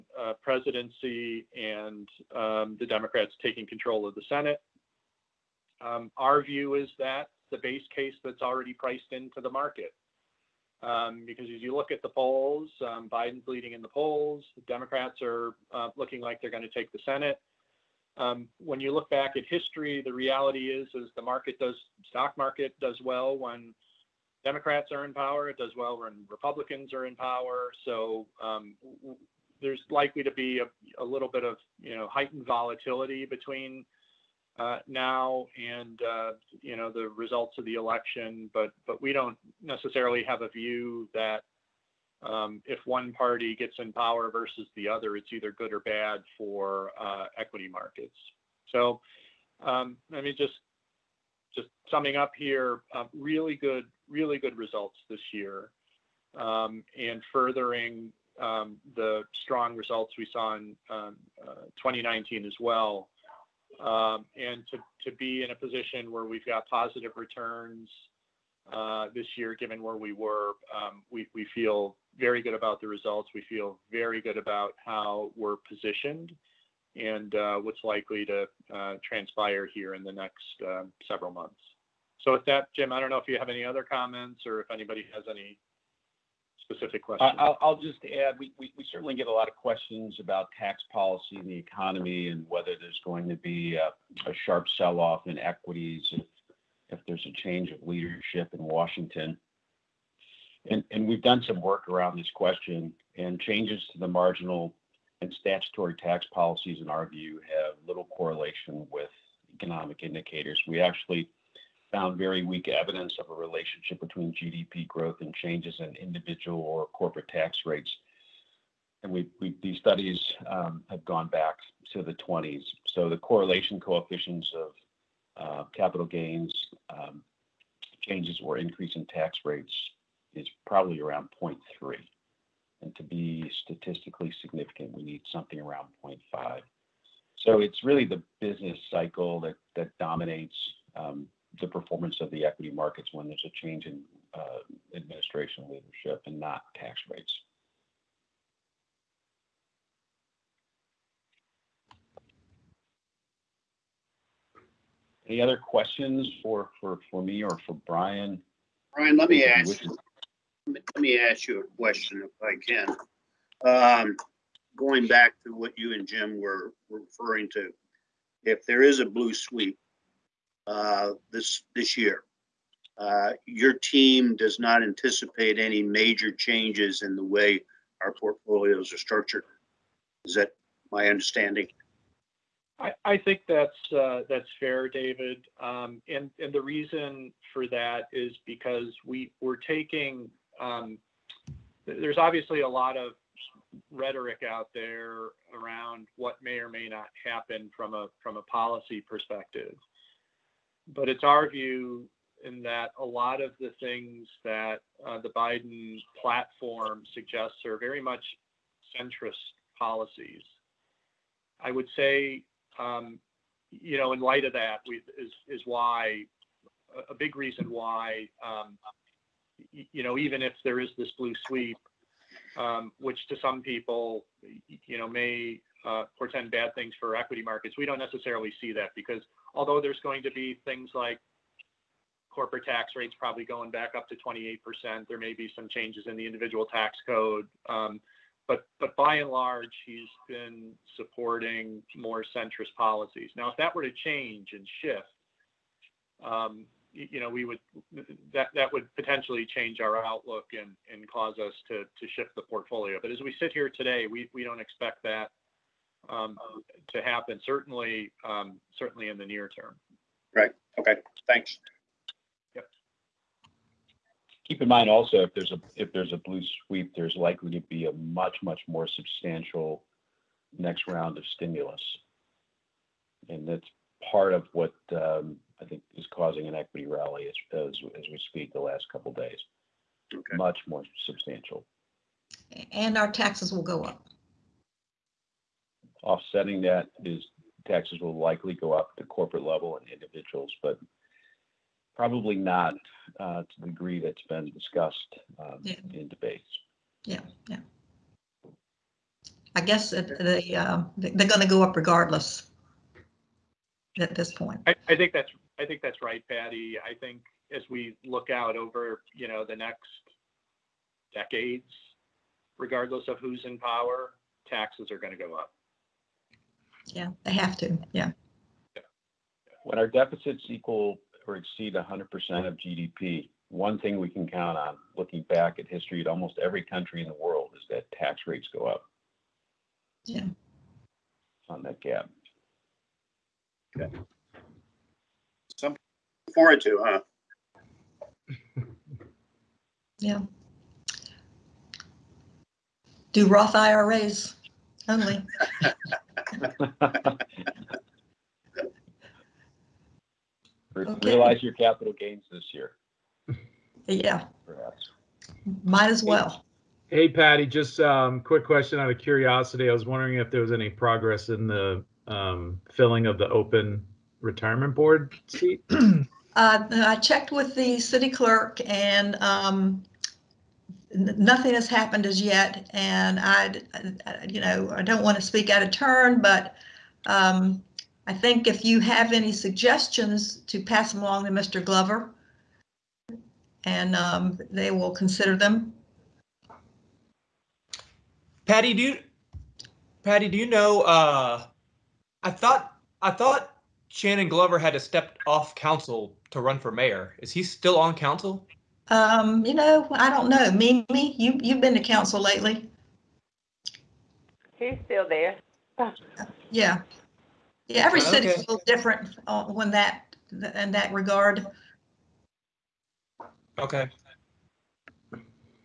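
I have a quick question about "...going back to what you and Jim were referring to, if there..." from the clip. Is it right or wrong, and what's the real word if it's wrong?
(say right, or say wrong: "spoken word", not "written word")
right.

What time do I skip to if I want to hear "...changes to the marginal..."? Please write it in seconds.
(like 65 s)
103 s.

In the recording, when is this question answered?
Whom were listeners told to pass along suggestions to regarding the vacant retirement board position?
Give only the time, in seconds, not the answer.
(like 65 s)
381 s.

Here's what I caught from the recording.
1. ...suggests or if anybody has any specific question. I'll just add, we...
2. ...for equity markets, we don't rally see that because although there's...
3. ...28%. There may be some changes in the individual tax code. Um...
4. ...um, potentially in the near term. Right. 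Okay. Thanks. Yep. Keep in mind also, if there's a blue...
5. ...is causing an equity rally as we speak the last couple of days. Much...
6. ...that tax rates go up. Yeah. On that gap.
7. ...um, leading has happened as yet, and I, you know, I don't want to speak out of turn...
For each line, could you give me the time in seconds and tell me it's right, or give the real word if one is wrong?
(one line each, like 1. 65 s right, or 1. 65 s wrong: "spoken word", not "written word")
1. 83 s wrong: "comments", not "suggests"
2. 226 s wrong: "necessarily", not "rally"
3. 234 s right
4. 258 s wrong: "certainly", not "potentially"
5. 275 s right
6. 327 s right
7. 369 s wrong: "nothing", not "leading".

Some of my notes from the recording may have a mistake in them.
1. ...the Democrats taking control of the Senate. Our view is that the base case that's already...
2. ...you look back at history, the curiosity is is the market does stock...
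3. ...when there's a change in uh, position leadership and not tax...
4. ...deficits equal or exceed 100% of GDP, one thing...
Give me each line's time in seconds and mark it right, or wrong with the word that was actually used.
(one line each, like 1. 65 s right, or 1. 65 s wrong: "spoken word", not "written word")
1. 2 s right
2. 18 s wrong: "reality", not "curiosity"
3. 143 s wrong: "administration", not "position"
4. 319 s right.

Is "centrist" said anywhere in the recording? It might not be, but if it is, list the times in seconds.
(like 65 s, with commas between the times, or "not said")
208 s, 242 s.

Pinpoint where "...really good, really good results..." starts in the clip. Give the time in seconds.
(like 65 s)
53 s.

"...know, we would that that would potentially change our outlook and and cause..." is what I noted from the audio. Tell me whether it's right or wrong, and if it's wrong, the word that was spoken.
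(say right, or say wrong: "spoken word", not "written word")
right.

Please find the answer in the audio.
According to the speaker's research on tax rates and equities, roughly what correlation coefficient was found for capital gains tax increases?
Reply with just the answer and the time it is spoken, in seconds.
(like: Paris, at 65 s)
0.3, at 131 s.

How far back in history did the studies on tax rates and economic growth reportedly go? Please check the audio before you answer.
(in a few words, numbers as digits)
the 20s.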